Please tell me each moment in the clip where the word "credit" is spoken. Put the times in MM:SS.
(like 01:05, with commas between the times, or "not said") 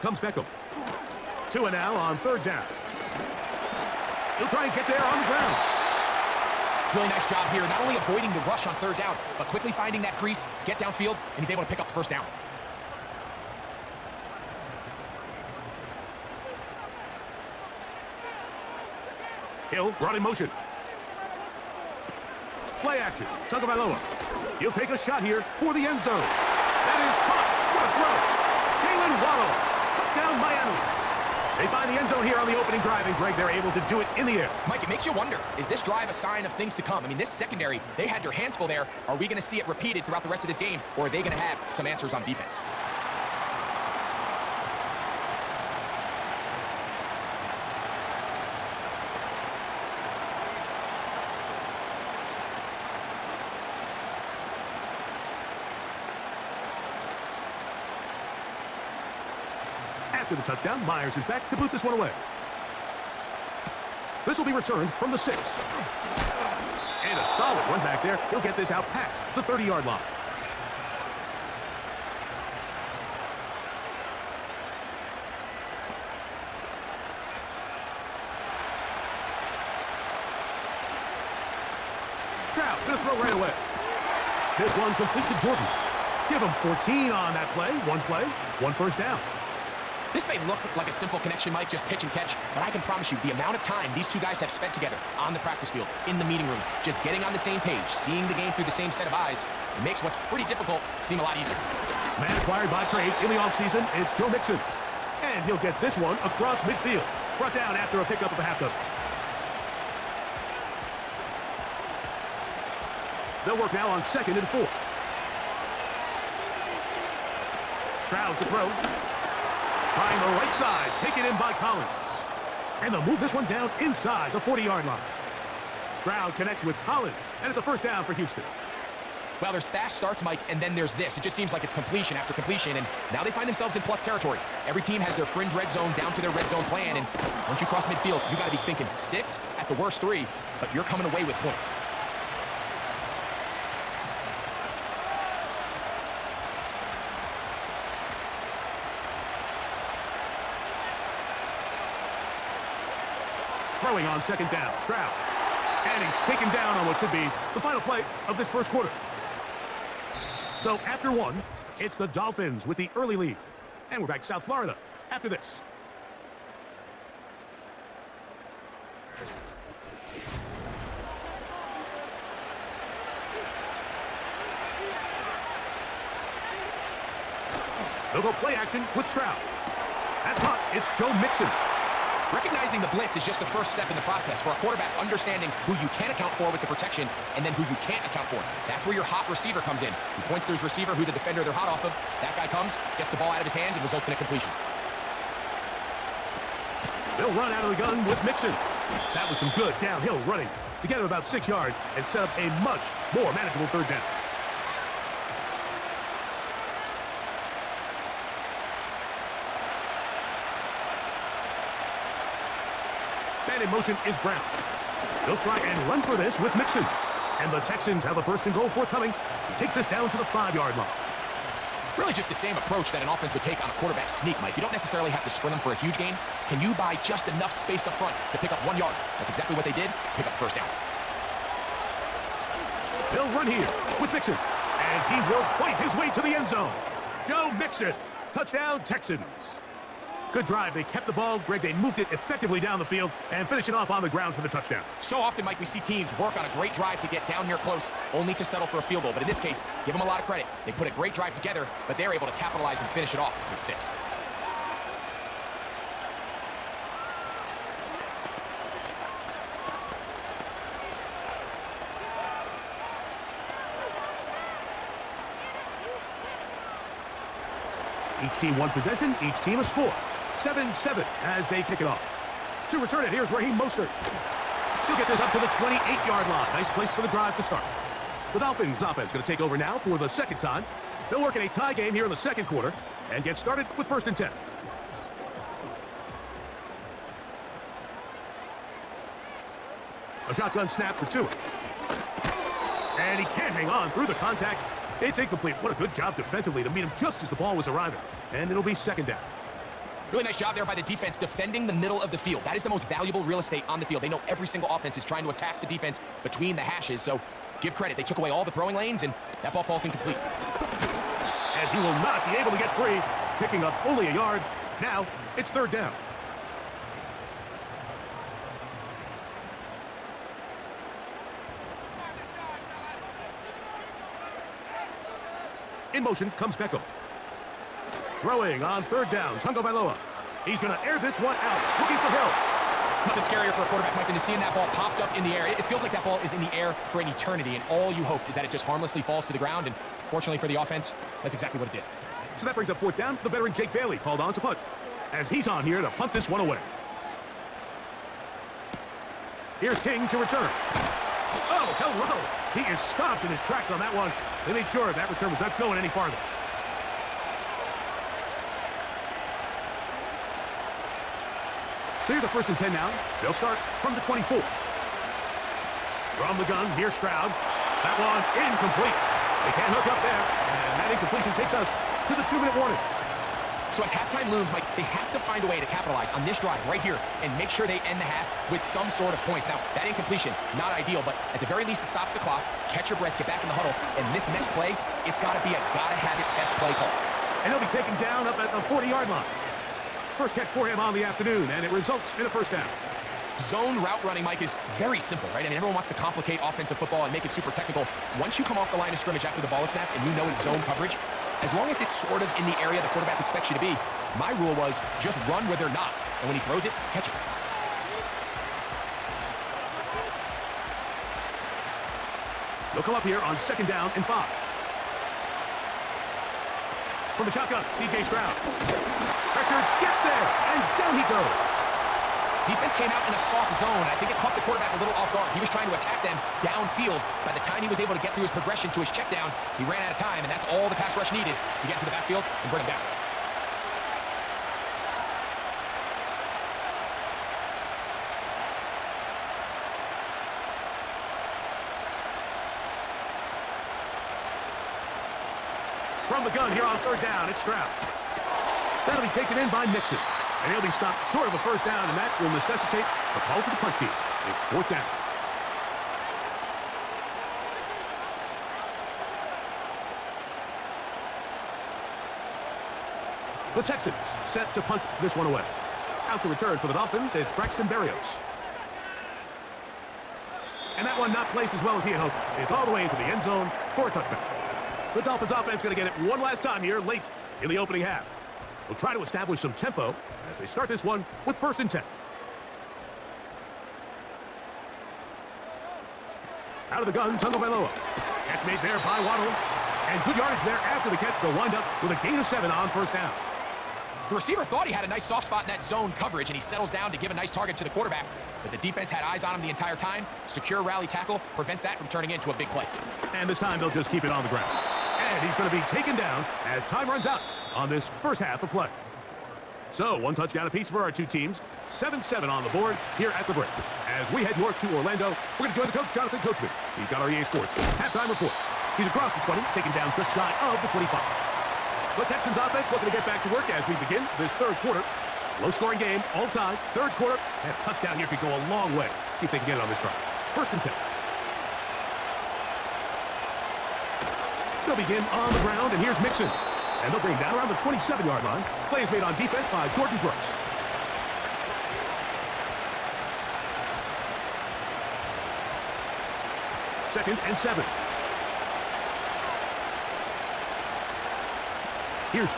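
04:10, 05:07.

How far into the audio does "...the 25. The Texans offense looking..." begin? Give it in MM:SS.
08:40.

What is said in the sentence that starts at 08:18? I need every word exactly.
But the defense had eyes on him the entire time.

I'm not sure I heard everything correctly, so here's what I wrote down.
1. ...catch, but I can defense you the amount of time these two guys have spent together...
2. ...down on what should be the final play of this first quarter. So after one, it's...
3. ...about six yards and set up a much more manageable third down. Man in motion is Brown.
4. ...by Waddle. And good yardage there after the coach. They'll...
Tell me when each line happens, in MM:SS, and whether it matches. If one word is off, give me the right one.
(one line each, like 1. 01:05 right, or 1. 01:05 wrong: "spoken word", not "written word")
1. 01:32 wrong: "promise", not "defense"
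2. 02:36 right
3. 03:21 right
4. 08:08 wrong: "catch", not "coach".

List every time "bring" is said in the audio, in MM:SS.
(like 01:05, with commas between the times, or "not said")
05:42, 07:12, 08:57.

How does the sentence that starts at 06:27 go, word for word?
And they'll be taken down up at the 40-yard line.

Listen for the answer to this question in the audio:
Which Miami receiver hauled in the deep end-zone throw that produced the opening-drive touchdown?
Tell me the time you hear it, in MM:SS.
00:28.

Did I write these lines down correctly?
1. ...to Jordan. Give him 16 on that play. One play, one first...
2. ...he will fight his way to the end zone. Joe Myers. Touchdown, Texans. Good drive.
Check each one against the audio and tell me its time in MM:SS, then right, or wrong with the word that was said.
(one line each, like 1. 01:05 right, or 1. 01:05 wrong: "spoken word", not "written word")
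1. 01:25 wrong: "14", not "16"
2. 03:55 wrong: "Mixon", not "Myers".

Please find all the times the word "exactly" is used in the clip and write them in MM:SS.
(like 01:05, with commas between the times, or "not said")
03:49, 05:41.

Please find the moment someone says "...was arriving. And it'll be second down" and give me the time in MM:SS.
04:57.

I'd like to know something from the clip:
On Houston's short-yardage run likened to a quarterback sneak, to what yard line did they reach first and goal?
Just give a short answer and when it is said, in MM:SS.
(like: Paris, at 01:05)
5, at 03:40.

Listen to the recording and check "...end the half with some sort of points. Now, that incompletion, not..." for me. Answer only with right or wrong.
right.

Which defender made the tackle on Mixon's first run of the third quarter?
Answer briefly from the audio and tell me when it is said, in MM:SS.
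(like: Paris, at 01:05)
Jordan Brooks, at 08:59.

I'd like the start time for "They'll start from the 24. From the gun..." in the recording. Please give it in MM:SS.
06:03.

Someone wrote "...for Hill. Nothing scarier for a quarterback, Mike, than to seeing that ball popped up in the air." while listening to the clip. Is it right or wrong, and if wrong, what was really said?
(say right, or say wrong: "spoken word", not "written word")
right.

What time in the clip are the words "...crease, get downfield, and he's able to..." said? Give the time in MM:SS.
00:10.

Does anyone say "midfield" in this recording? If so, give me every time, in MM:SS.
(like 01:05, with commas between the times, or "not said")
01:46, 02:17.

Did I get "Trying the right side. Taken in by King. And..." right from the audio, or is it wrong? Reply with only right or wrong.
wrong.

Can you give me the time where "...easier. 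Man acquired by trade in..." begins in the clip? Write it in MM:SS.
01:41.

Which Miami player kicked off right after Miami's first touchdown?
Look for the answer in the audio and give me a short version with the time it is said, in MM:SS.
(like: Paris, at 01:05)
Myers, at 01:00.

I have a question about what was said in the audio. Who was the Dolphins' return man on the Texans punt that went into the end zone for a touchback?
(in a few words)
Braxton Berrios.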